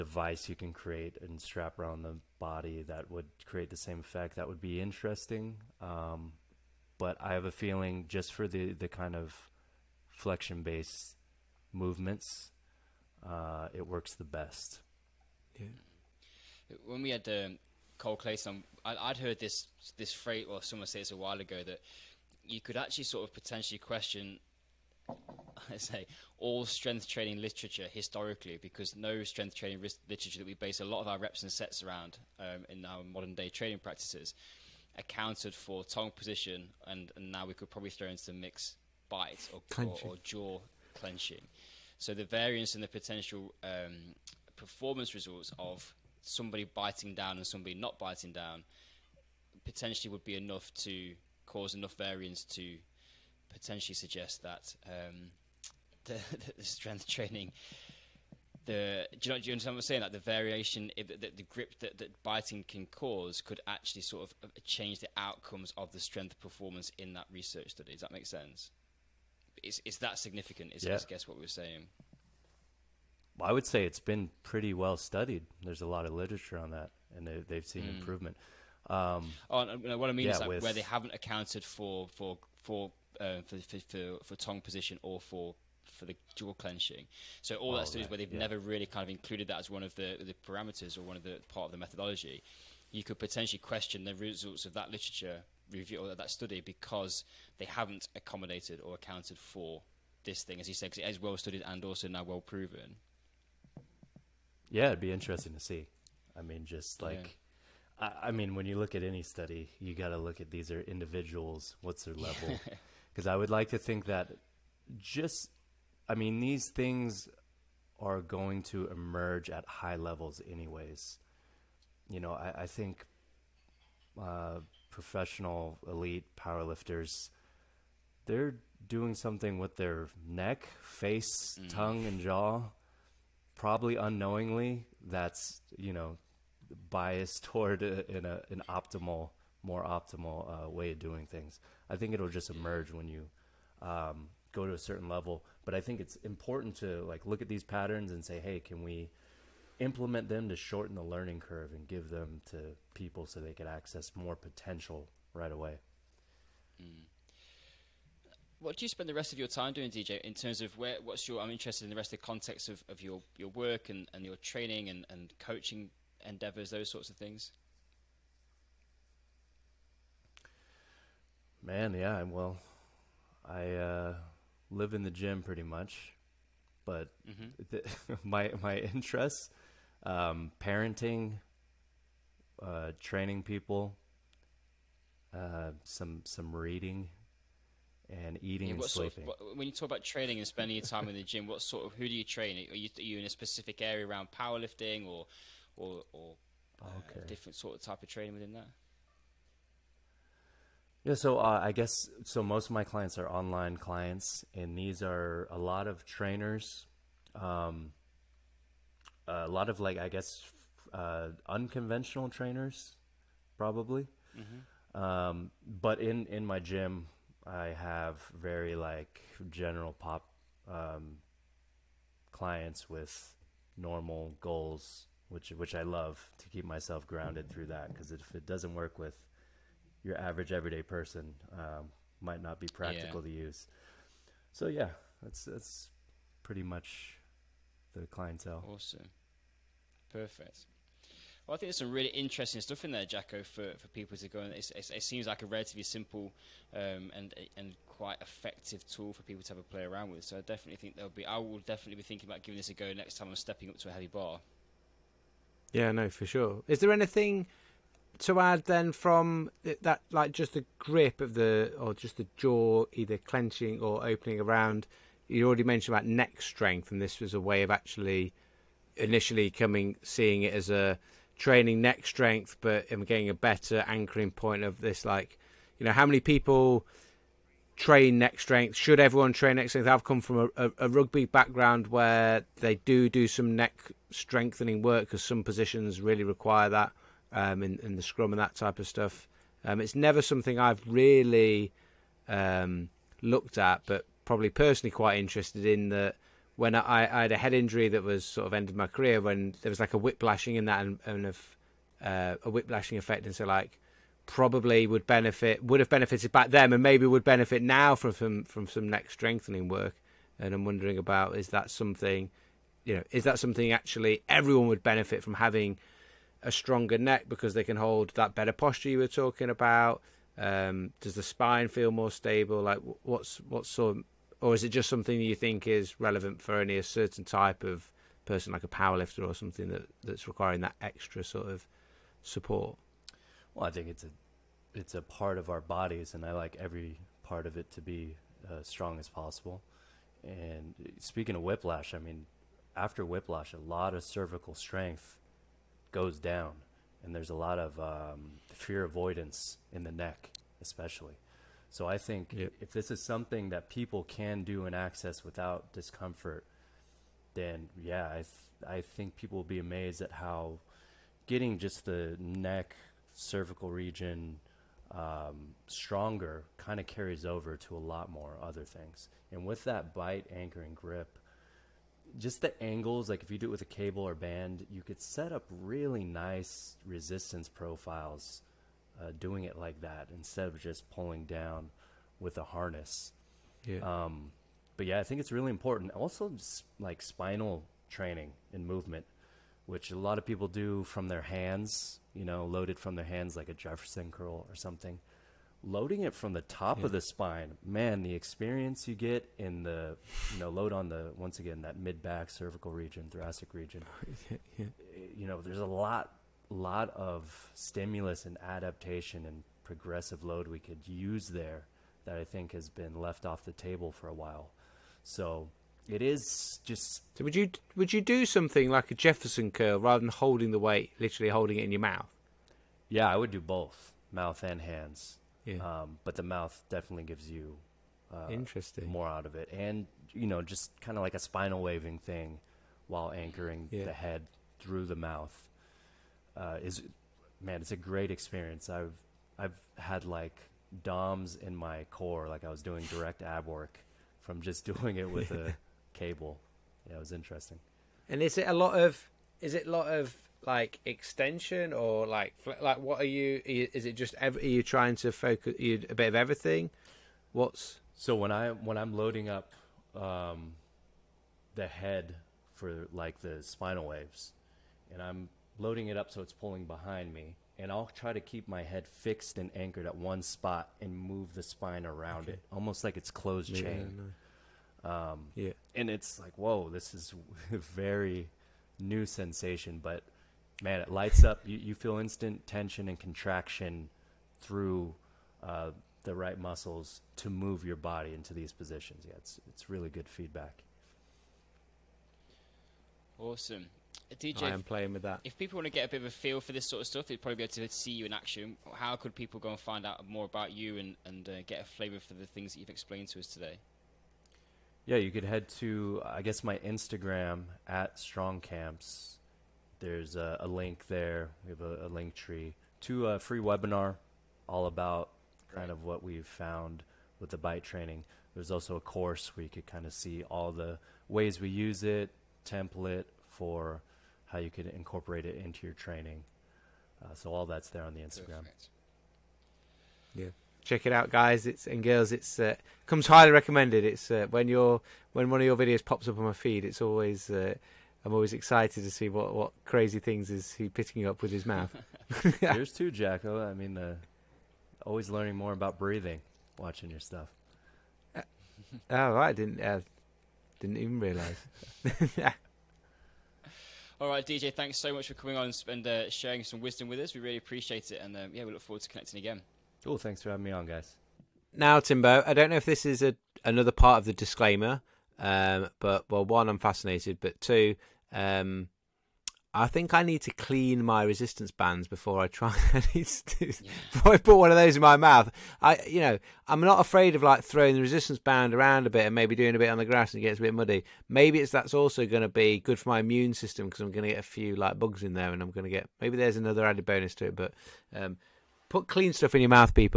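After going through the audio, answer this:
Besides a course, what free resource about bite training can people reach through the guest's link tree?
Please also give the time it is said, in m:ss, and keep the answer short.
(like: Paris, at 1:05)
Free webinar, at 8:33.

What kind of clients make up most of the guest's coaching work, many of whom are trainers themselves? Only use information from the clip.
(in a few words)
Online clients.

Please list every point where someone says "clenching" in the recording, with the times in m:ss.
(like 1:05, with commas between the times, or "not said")
0:40, 1:26, 4:23.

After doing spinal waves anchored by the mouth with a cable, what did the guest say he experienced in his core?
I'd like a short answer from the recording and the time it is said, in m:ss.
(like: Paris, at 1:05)
DOMs, at 7:20.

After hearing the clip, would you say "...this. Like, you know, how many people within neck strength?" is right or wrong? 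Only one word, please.
wrong.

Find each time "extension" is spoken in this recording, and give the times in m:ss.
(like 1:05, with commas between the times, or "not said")
7:30.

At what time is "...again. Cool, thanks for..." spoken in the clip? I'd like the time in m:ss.
9:19.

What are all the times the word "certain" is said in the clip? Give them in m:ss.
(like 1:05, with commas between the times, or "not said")
2:24, 5:26.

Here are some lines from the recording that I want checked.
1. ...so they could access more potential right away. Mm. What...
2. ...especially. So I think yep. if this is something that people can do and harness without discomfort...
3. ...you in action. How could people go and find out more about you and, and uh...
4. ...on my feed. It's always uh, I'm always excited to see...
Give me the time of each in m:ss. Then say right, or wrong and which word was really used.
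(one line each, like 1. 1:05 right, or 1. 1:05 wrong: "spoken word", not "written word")
1. 2:33 right
2. 5:50 wrong: "access", not "harness"
3. 8:17 right
4. 8:56 right.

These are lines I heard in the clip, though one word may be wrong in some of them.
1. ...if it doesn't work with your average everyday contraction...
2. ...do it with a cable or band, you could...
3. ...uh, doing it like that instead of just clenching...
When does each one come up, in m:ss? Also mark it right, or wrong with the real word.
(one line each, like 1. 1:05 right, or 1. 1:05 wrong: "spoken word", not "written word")
1. 3:48 wrong: "person", not "contraction"
2. 6:13 right
3. 6:19 wrong: "pulling", not "clenching".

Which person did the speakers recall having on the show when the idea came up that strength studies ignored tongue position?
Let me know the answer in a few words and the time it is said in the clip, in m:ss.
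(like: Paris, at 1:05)
Cole Clayson, at 0:17.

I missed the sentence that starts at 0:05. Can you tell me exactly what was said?
Um, but I have a feeling just for the, the kind of flexion based movements, uh, it works the best.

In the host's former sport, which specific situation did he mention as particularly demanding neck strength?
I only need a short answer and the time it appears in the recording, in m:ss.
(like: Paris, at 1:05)
The scrum, at 4:48.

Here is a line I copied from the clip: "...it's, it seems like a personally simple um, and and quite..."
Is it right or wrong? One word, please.
wrong.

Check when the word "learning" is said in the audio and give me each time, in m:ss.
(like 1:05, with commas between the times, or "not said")
2:31, 9:05.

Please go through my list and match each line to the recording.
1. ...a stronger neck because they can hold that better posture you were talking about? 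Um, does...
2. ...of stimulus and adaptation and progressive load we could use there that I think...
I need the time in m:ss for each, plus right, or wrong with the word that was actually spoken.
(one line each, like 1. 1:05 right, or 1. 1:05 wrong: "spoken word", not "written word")
1. 5:16 right
2. 6:46 right.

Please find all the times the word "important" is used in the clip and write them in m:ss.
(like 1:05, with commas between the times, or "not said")
2:26, 6:25.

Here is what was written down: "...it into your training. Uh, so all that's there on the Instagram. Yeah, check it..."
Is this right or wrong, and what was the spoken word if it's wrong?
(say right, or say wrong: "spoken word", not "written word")
right.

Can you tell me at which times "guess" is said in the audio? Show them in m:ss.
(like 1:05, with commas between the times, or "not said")
1:11, 3:21, 3:30, 8:26.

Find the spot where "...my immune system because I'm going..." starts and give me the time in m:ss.
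9:42.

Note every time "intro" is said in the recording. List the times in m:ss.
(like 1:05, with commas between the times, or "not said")
not said.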